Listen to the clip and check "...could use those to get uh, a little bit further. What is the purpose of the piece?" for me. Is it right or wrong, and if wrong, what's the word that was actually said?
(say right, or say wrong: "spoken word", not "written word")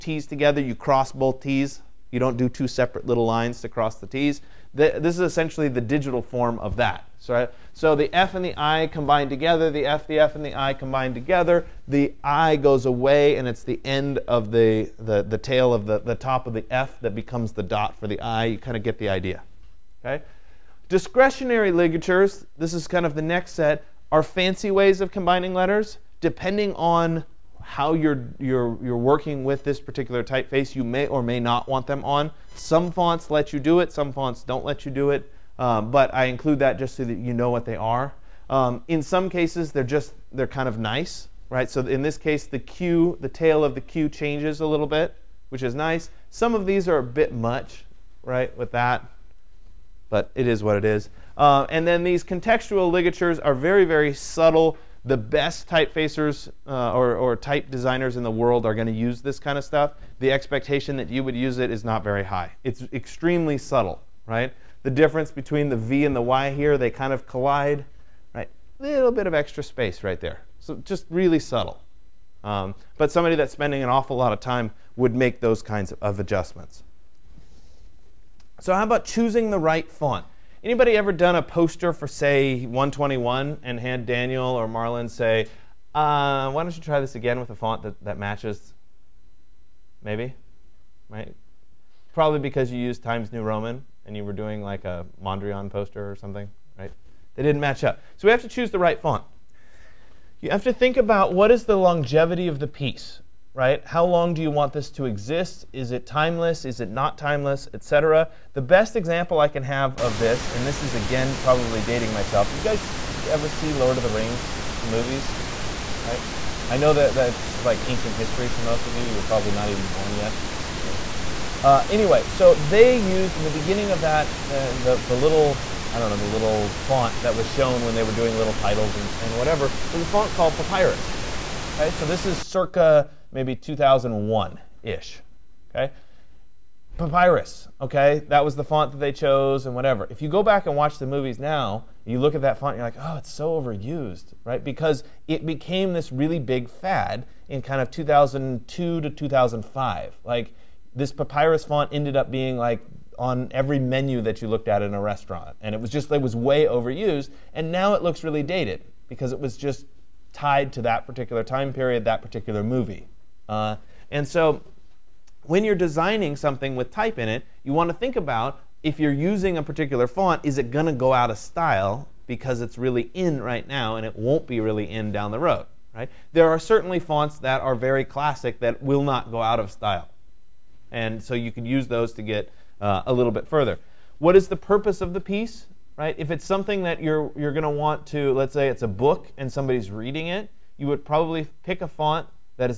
right.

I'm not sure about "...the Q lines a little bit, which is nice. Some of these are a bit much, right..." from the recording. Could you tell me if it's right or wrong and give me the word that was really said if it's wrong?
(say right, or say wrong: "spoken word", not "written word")
wrong: "changes", not "lines".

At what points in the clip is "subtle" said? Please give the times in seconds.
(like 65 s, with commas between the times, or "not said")
54 s, 63 s, 71 s.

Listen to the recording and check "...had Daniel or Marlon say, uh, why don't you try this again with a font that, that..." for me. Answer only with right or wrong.
right.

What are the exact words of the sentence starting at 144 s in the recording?
Because it became this really big fad in kind of 2002 to 2005.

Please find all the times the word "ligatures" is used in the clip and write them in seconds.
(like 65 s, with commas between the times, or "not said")
21 s, 52 s.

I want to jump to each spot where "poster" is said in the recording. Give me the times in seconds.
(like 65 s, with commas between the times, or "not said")
81 s, 95 s.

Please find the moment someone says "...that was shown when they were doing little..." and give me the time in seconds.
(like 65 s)
127 s.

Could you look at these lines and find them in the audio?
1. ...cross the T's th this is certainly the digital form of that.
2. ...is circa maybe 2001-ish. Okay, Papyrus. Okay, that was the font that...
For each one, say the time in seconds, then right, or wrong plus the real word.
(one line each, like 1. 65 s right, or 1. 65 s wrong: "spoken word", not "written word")
1. 3 s wrong: "essentially", not "certainly"
2. 132 s right.